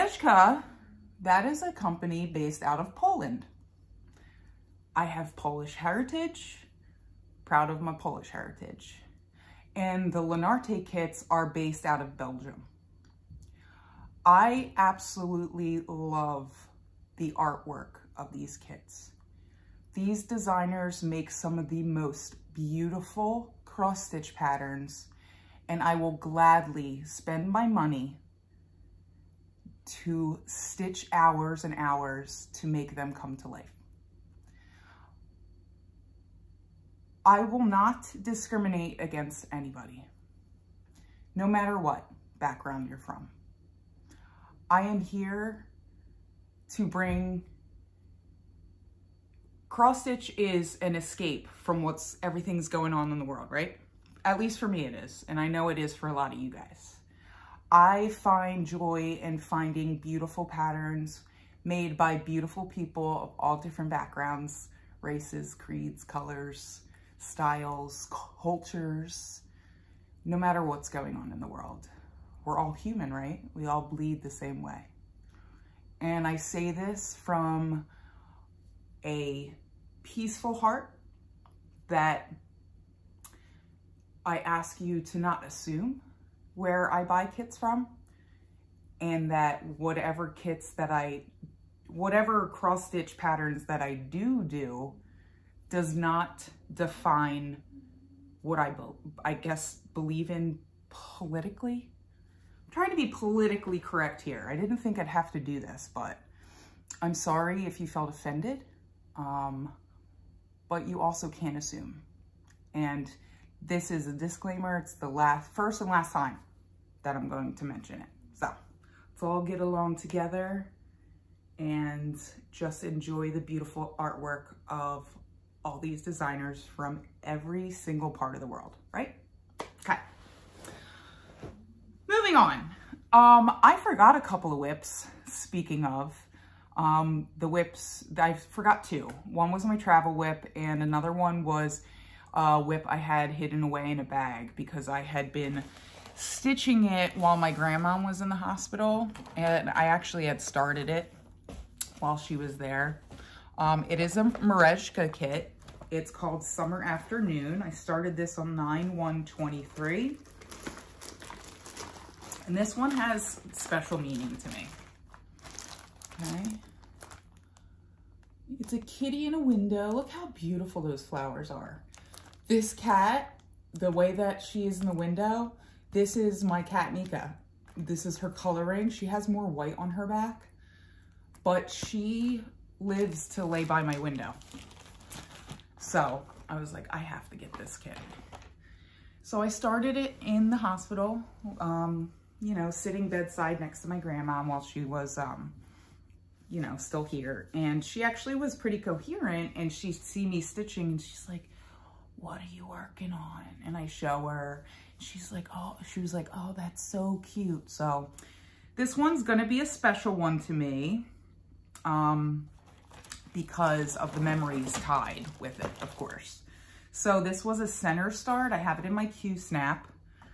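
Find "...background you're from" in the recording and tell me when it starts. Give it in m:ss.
0:42.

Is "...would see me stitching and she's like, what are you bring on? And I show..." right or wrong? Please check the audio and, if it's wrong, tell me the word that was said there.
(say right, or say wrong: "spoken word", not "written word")
wrong: "working", not "bring".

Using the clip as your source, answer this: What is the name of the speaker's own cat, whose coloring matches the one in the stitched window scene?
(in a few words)
Nika.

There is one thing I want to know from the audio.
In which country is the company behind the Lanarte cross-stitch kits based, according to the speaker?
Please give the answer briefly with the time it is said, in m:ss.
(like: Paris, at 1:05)
Belgium, at 0:12.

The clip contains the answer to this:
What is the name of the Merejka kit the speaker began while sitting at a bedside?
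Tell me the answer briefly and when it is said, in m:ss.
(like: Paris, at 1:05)
Summer Afternoon, at 2:36.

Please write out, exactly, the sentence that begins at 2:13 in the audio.
Um, I forgot a couple of whips, speaking of.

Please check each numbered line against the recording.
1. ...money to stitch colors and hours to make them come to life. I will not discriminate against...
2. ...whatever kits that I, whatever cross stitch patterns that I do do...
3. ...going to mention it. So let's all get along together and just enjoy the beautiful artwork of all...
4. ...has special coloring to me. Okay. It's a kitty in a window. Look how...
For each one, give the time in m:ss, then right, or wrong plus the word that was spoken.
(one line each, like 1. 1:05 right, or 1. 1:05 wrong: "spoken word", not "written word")
1. 0:27 wrong: "hours", not "colors"
2. 1:29 right
3. 1:57 right
4. 2:42 wrong: "meaning", not "coloring".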